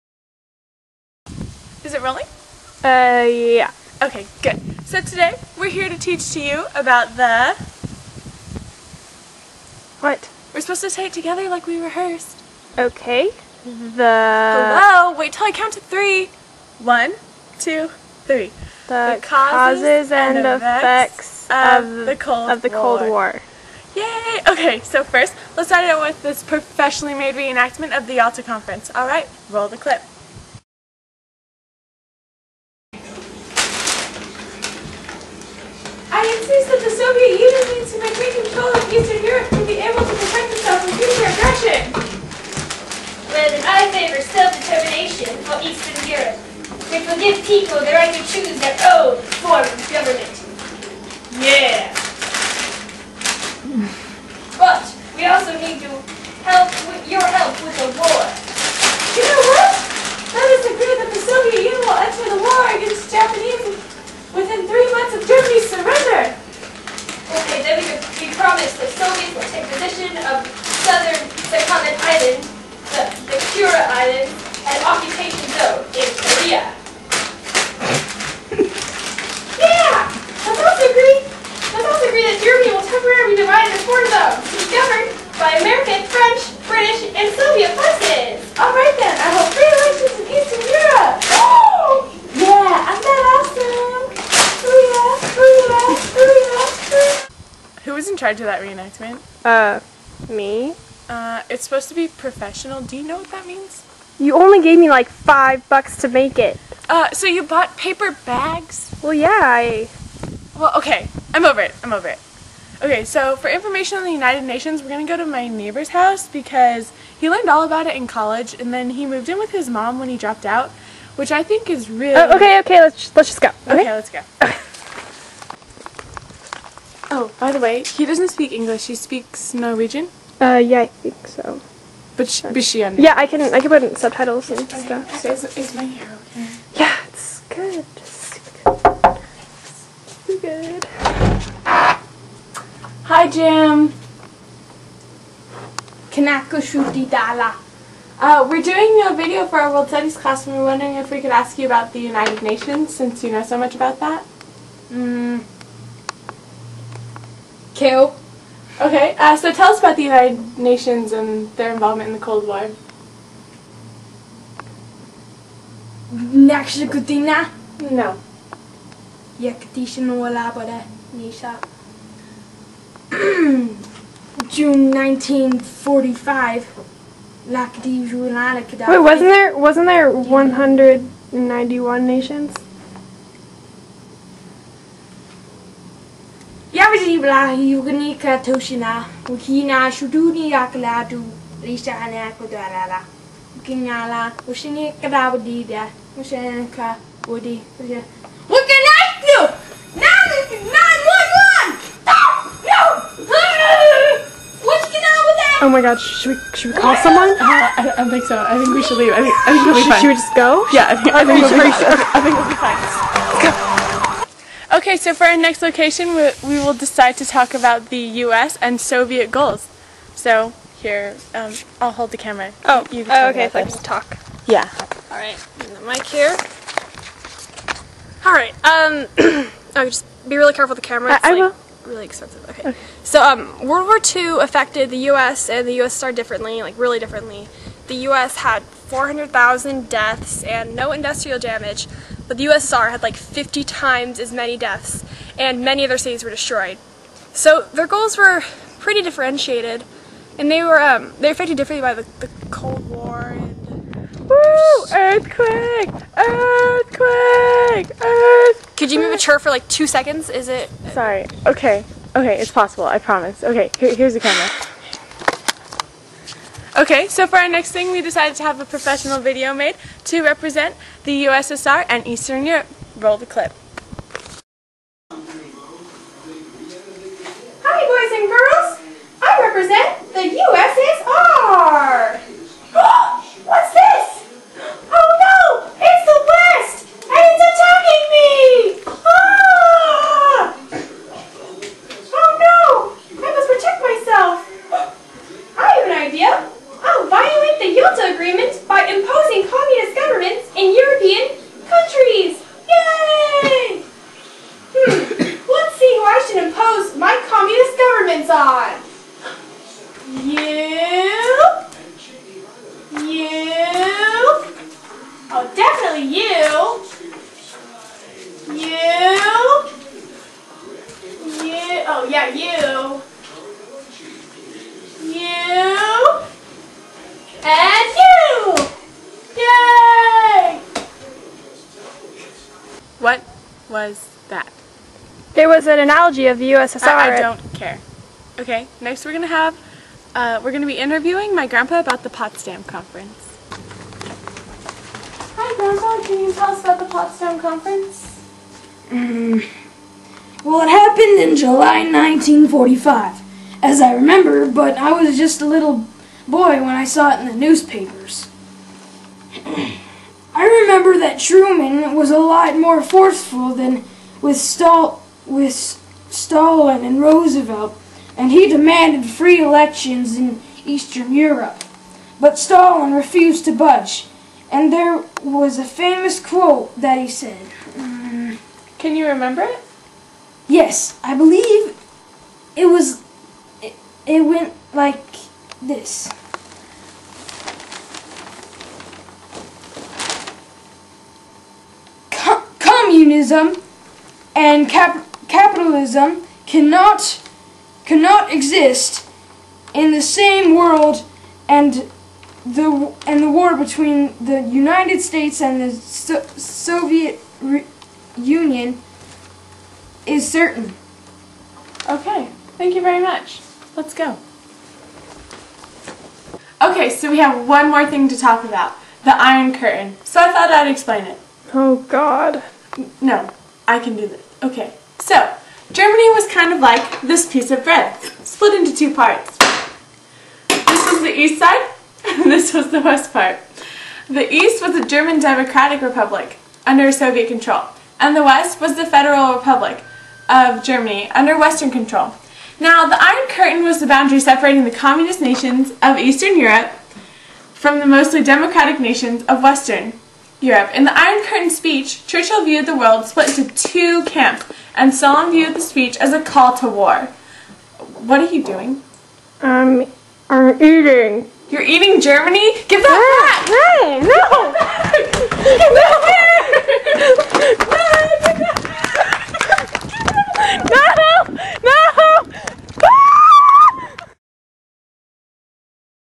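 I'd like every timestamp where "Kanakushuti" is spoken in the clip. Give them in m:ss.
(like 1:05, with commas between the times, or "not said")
2:26.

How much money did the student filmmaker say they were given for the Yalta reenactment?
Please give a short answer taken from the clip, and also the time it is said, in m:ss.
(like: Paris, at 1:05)
5 dollars, at 1:45.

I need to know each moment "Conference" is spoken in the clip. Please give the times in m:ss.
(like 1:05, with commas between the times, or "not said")
0:28, 5:42, 5:47.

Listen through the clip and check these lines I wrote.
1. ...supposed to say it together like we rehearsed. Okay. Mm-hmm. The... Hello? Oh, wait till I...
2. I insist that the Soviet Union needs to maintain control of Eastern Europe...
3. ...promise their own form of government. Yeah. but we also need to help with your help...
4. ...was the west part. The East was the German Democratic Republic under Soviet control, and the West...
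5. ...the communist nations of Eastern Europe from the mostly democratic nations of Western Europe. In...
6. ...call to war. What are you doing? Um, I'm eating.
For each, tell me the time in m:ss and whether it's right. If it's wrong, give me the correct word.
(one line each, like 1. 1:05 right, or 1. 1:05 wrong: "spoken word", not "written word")
1. 0:10 right
2. 0:36 right
3. 0:48 wrong: "choose", not "promise"
4. 7:12 right
5. 7:24 right
6. 7:36 right.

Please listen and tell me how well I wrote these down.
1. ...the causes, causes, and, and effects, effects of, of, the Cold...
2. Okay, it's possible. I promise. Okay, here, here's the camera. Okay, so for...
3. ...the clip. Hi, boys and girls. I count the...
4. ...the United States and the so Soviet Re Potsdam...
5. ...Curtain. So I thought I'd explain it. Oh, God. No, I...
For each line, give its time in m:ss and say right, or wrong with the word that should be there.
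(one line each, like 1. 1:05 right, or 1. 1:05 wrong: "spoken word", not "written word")
1. 0:19 right
2. 4:22 right
3. 4:33 wrong: "represent", not "count"
4. 6:44 wrong: "Union", not "Potsdam"
5. 6:59 right.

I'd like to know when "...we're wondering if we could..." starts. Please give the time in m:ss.
2:30.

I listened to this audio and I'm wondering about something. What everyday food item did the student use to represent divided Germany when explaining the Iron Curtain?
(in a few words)
bread.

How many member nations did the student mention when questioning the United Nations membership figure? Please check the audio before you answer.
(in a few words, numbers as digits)
191.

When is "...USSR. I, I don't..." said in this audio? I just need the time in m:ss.
5:36.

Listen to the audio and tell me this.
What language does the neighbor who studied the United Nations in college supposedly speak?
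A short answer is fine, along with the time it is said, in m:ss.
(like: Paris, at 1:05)
Norwegian, at 2:09.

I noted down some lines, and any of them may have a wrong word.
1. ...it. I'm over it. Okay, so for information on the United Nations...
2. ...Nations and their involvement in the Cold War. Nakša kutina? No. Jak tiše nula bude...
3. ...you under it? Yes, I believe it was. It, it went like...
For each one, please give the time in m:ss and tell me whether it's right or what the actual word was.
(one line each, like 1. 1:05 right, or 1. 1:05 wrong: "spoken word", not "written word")
1. 1:51 right
2. 2:40 right
3. 6:18 wrong: "remember", not "under".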